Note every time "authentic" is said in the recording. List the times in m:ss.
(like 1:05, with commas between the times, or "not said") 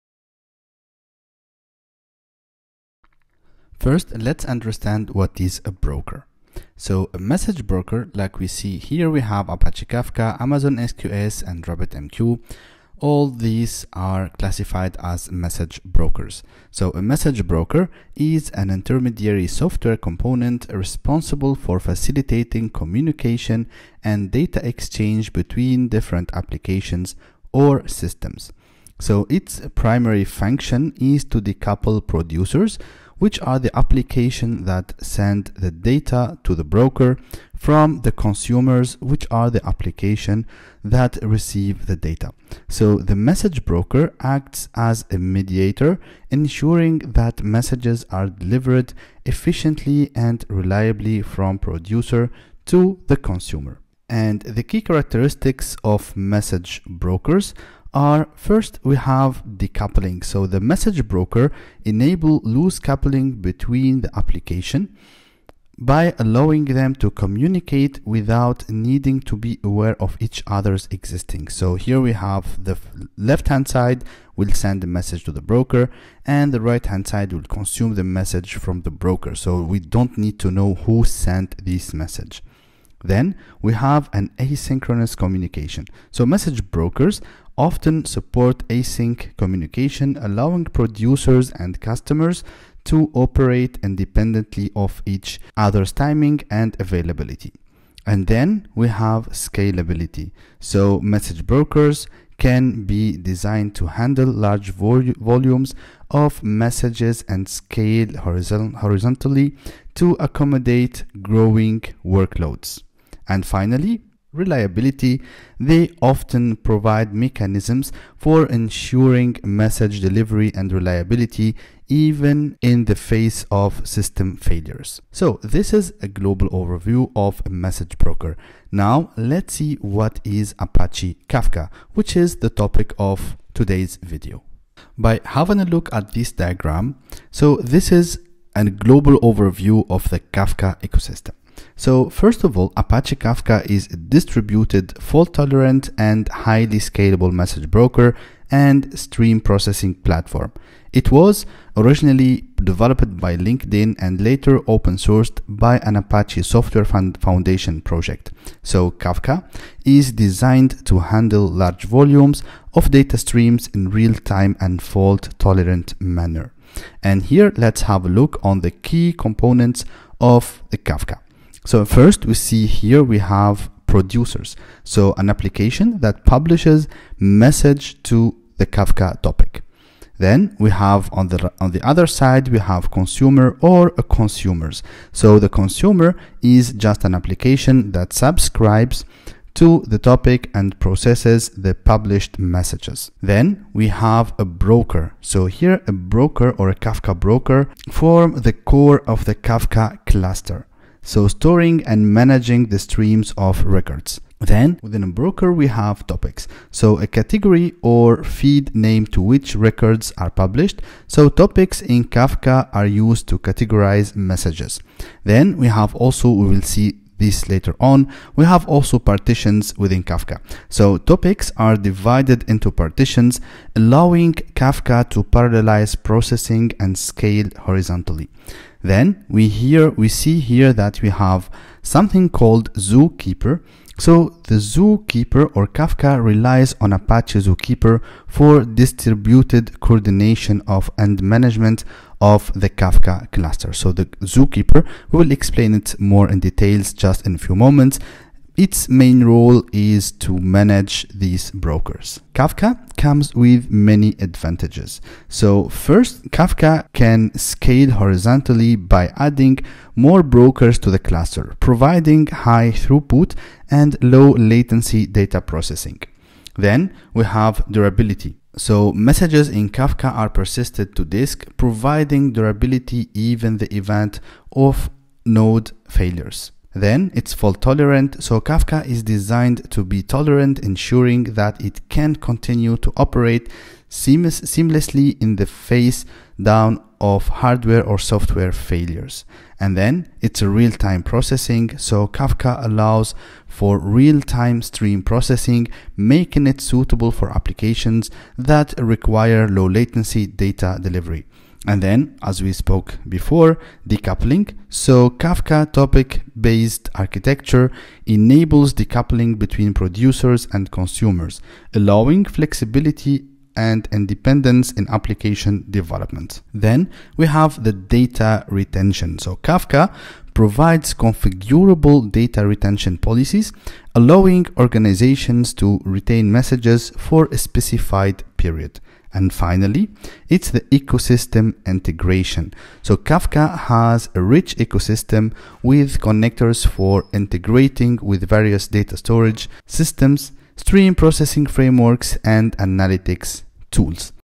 not said.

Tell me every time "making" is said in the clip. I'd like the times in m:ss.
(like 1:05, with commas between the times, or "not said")
4:55.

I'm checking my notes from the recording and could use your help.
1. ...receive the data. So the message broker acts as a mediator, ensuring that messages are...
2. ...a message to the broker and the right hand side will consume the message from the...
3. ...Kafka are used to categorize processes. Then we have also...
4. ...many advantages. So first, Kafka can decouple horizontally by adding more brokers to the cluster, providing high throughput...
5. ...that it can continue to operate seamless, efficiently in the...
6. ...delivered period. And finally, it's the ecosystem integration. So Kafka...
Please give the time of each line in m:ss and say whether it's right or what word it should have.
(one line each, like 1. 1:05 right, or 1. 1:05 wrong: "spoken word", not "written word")
1. 0:41 right
2. 1:14 right
3. 3:32 wrong: "messages", not "processes"
4. 4:13 wrong: "scale", not "decouple"
5. 4:41 wrong: "seamlessly", not "efficiently"
6. 5:27 wrong: "specified", not "delivered".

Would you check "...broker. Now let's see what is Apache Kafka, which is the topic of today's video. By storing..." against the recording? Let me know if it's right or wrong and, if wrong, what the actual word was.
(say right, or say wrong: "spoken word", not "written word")
wrong: "having", not "storing".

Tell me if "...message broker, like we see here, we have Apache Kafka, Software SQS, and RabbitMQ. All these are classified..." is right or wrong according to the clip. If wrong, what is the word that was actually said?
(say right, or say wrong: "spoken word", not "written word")
wrong: "Amazon", not "Software".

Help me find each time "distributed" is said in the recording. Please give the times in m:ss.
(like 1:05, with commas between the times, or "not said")
2:23, 3:58.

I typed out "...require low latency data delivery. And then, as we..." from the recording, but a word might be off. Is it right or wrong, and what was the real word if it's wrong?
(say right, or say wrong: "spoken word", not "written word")
right.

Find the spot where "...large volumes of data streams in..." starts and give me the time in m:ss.
2:41.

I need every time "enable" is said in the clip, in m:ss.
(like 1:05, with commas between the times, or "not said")
1:01, 5:08.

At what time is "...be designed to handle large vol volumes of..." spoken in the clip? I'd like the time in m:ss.
1:42.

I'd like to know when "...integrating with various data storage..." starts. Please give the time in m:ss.
5:37.